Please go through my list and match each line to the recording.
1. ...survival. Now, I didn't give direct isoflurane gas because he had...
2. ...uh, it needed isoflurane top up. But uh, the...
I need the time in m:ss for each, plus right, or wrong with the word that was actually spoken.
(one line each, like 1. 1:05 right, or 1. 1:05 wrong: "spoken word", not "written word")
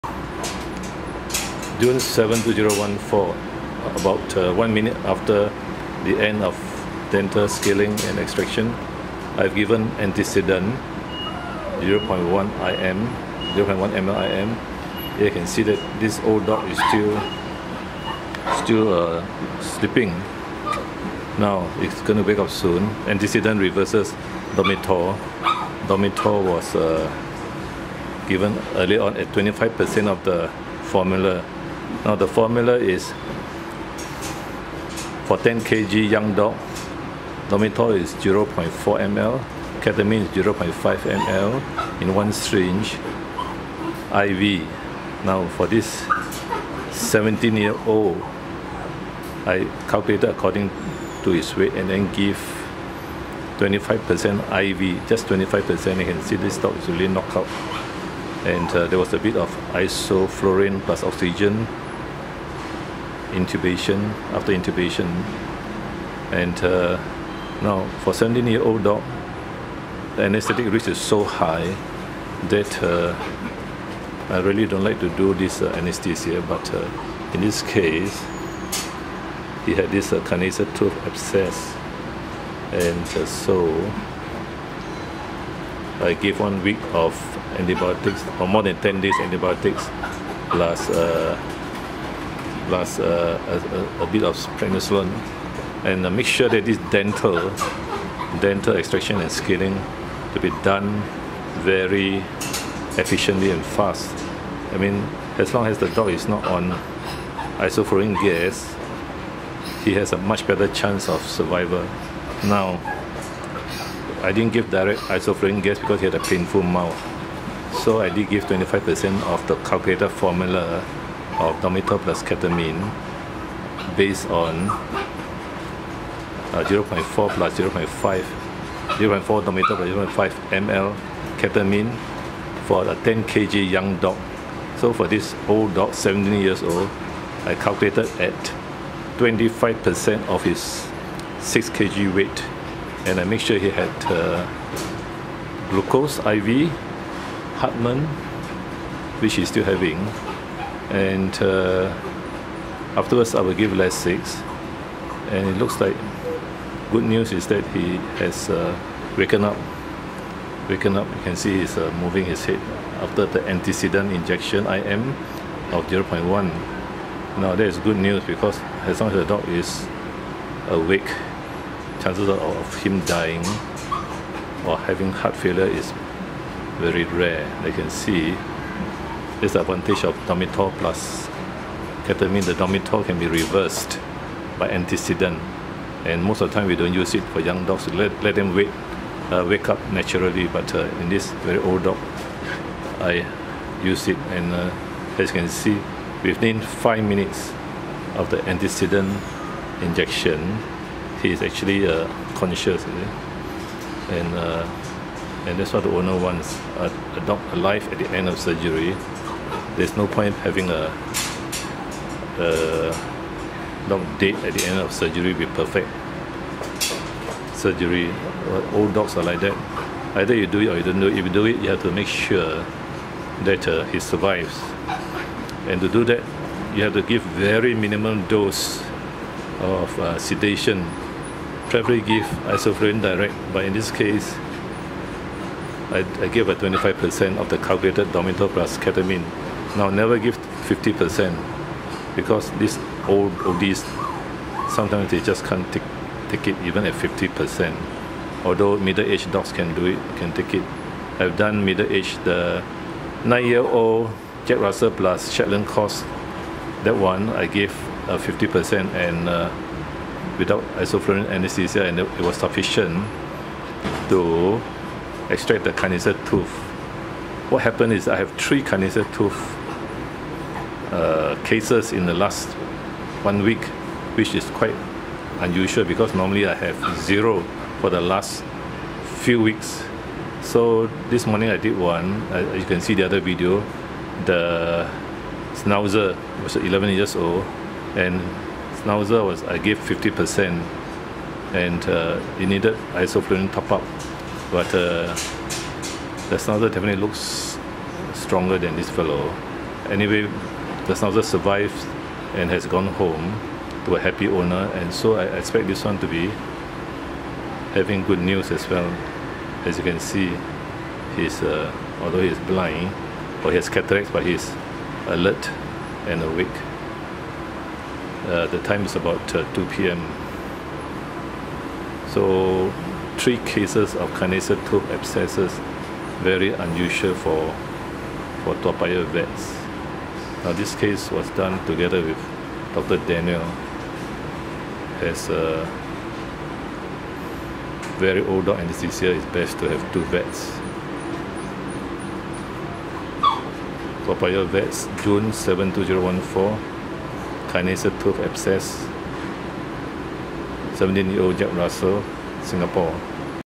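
1. 1:51 right
2. 4:51 right.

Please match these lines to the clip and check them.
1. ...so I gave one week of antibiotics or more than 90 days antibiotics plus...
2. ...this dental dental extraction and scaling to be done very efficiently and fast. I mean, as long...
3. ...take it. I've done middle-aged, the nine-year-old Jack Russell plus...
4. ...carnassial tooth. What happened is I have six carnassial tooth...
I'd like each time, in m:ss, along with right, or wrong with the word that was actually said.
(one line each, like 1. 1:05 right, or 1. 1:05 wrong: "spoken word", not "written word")
1. 1:23 wrong: "10", not "90"
2. 1:36 right
3. 4:10 right
4. 4:25 wrong: "three", not "six".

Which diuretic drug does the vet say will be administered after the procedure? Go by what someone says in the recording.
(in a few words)
Lasix.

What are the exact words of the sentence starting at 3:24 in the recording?
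And uh, and that's what the owner wants.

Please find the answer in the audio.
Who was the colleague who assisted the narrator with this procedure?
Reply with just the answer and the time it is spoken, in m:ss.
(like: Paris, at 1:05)
Dr. Daniel, at 5:32.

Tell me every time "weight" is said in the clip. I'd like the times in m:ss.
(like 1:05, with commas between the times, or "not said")
0:51, 2:22.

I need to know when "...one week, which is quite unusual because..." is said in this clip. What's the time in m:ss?
4:33.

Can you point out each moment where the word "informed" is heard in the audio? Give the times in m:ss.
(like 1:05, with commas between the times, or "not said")
not said.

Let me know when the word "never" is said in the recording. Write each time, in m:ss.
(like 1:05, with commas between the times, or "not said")
3:59.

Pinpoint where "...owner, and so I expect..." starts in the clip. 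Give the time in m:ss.
5:04.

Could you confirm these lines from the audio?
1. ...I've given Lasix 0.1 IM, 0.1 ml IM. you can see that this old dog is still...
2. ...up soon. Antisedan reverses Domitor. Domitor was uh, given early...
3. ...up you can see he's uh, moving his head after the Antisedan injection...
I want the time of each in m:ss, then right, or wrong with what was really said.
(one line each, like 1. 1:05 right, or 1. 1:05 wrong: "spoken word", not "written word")
1. 0:09 wrong: "Antisedan", not "Lasix"
2. 0:22 right
3. 2:40 right.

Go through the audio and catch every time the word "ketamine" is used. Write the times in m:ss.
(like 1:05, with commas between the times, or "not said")
0:39, 2:02, 2:11, 3:02, 3:58.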